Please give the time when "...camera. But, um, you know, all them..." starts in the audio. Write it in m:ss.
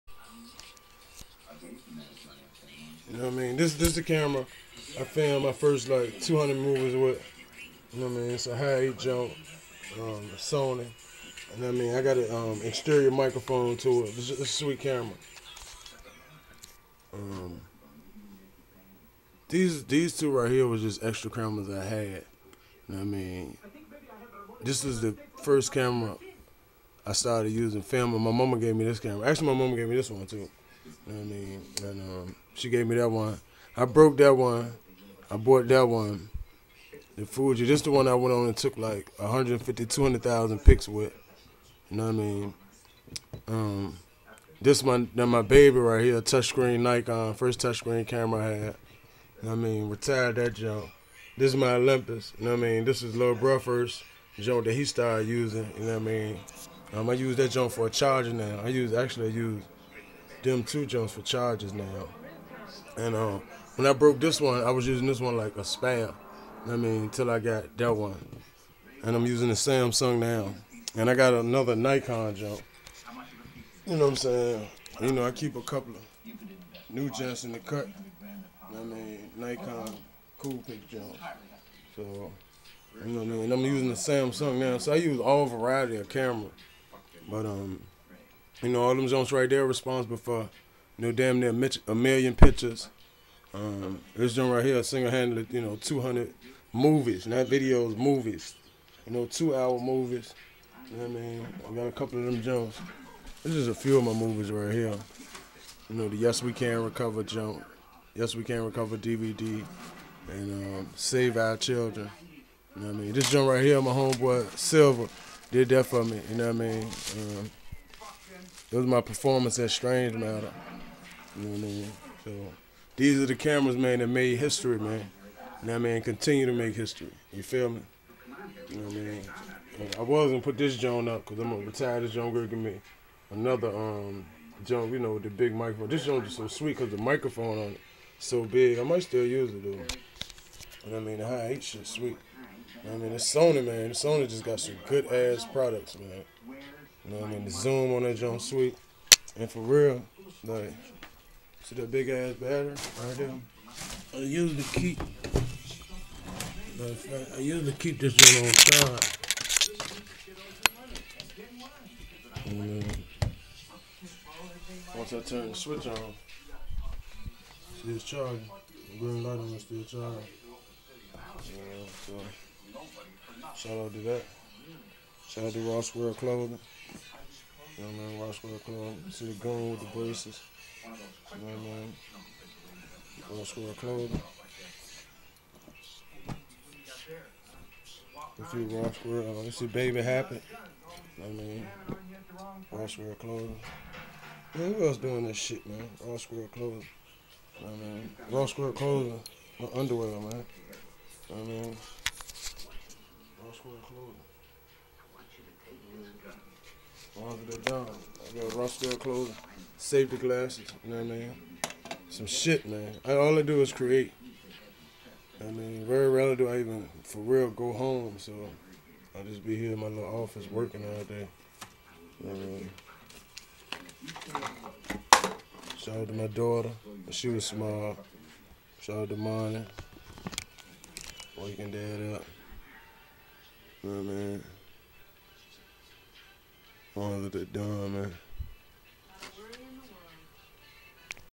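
1:26.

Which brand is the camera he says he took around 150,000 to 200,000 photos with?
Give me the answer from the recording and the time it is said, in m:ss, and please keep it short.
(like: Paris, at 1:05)
Fuji, at 0:37.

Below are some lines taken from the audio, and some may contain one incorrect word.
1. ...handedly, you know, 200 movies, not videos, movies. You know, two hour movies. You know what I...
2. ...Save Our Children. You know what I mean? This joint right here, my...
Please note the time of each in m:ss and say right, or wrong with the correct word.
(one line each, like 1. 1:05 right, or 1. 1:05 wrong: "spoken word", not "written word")
1. 1:35 right
2. 1:50 right.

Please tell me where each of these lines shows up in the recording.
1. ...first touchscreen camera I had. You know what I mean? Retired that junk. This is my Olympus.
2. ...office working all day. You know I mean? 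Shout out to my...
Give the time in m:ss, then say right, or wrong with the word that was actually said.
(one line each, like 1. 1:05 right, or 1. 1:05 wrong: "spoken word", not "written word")
1. 0:47 right
2. 3:40 right.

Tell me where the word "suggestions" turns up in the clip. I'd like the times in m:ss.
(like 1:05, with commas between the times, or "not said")
not said.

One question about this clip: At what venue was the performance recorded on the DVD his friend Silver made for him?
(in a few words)
Strange Matter.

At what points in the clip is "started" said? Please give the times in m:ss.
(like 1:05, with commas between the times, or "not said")
0:27, 0:54.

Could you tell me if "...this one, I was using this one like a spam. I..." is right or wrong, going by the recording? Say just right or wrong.
right.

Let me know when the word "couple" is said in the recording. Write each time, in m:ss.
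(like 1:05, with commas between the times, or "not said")
1:15, 1:41.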